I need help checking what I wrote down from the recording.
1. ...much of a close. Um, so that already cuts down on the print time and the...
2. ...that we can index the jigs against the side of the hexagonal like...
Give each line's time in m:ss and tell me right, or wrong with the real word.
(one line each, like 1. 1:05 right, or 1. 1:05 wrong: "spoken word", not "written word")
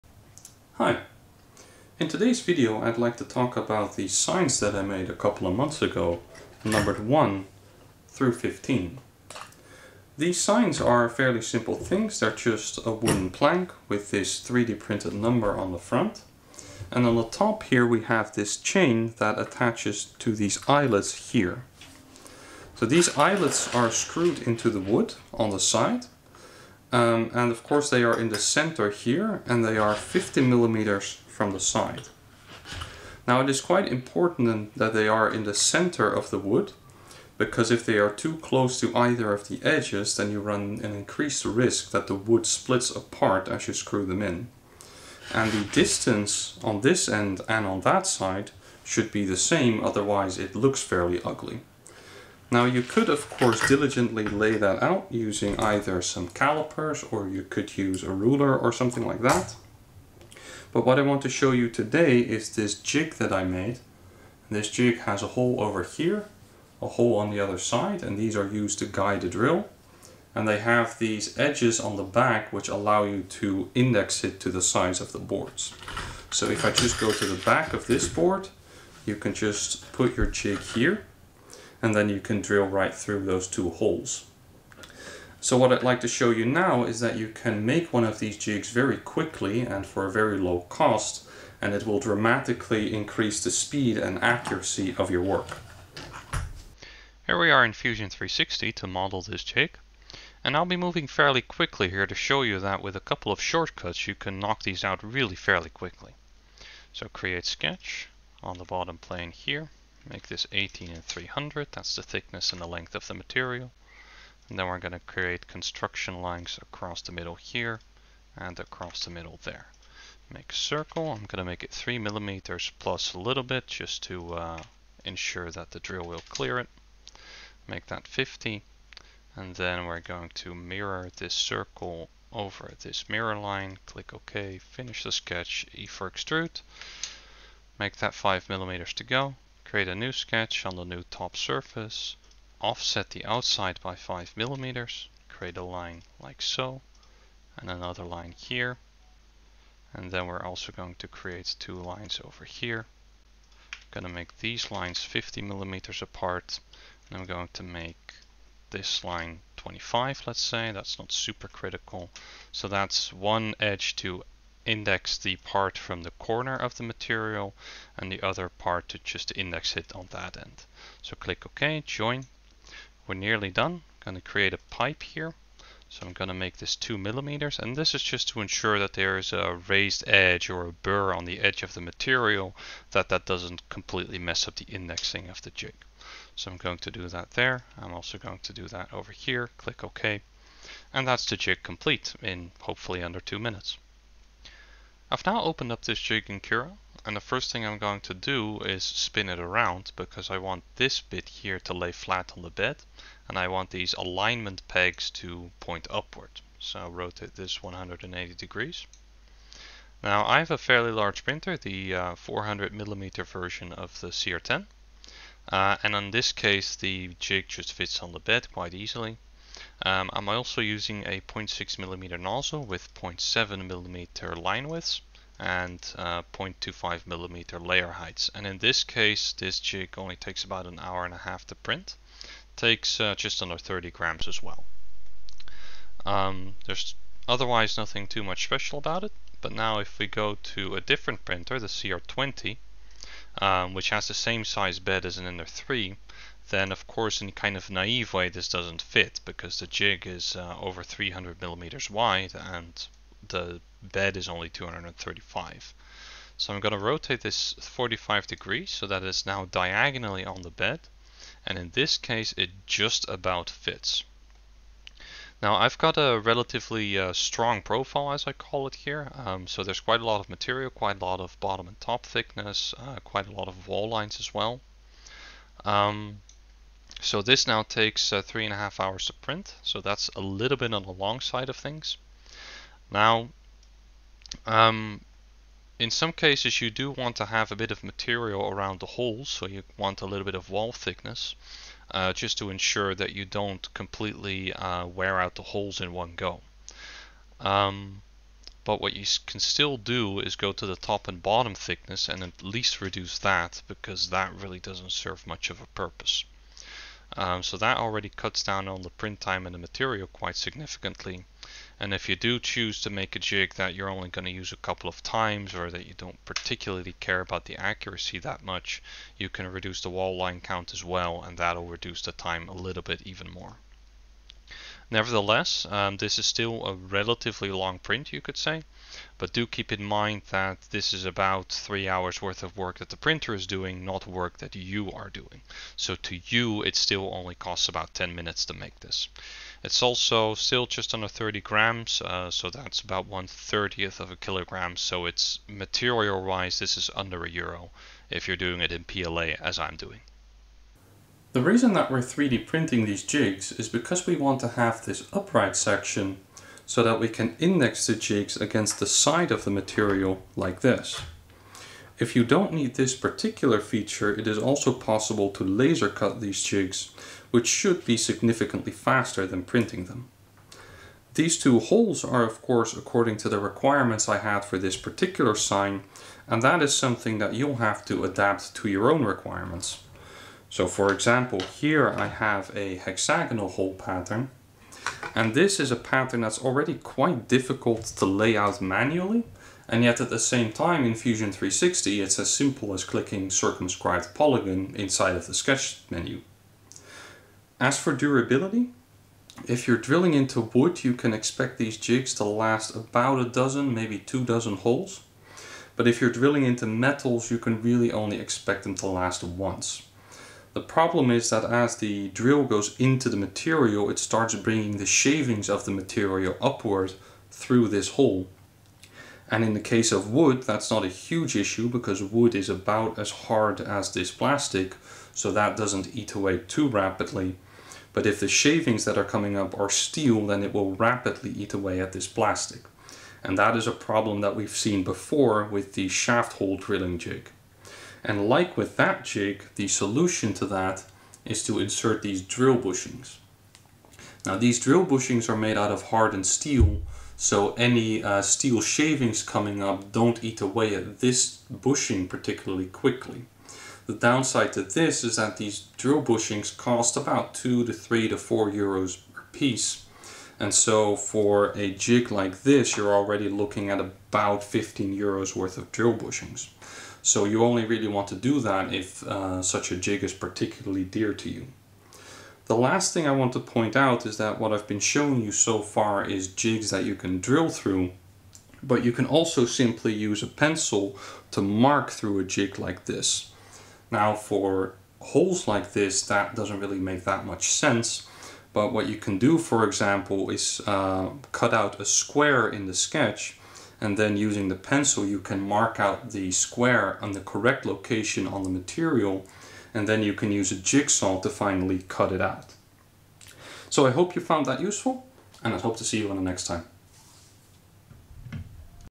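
1. 5:05 wrong: "purpose", not "close"
2. 5:56 wrong: "material", not "hexagonal".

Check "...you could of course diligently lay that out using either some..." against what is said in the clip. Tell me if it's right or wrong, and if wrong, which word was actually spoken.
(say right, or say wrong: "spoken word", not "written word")
right.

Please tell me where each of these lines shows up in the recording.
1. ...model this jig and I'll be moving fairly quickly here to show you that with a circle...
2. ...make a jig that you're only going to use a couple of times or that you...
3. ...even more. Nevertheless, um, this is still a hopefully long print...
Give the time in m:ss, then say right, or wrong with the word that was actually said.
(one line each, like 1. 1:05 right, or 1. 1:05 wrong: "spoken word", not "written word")
1. 1:38 wrong: "couple", not "circle"
2. 5:12 right
3. 5:23 wrong: "relatively", not "hopefully".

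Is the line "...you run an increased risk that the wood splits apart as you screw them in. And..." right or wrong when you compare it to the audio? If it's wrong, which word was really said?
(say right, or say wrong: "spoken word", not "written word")
right.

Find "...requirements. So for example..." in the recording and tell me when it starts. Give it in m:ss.
6:19.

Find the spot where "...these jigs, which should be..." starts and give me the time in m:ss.
6:06.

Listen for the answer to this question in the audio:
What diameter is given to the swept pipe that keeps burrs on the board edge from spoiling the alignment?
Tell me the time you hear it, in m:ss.
2:56.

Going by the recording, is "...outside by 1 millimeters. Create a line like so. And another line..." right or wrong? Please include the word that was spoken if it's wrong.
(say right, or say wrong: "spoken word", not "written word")
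wrong: "5", not "1".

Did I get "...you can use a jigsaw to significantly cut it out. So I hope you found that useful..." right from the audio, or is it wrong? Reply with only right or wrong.
wrong.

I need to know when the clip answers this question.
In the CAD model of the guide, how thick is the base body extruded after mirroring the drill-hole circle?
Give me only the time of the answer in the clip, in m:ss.
2:18.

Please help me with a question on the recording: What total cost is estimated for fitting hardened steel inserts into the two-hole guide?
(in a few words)
15 euros.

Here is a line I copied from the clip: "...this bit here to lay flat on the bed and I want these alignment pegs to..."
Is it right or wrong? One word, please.
right.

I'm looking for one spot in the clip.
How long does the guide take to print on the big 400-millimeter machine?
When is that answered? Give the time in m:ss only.
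3:50.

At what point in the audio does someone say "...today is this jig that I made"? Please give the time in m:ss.
1:01.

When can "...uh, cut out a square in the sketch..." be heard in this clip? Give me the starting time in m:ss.
8:10.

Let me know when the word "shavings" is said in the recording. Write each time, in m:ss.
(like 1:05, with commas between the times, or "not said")
6:54, 7:08, 7:28.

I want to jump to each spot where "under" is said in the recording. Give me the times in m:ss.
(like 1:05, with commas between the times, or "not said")
3:13, 3:53, 5:40, 5:46.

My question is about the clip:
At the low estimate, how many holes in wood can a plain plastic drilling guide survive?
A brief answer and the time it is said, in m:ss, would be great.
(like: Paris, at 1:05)
A dozen, at 6:43.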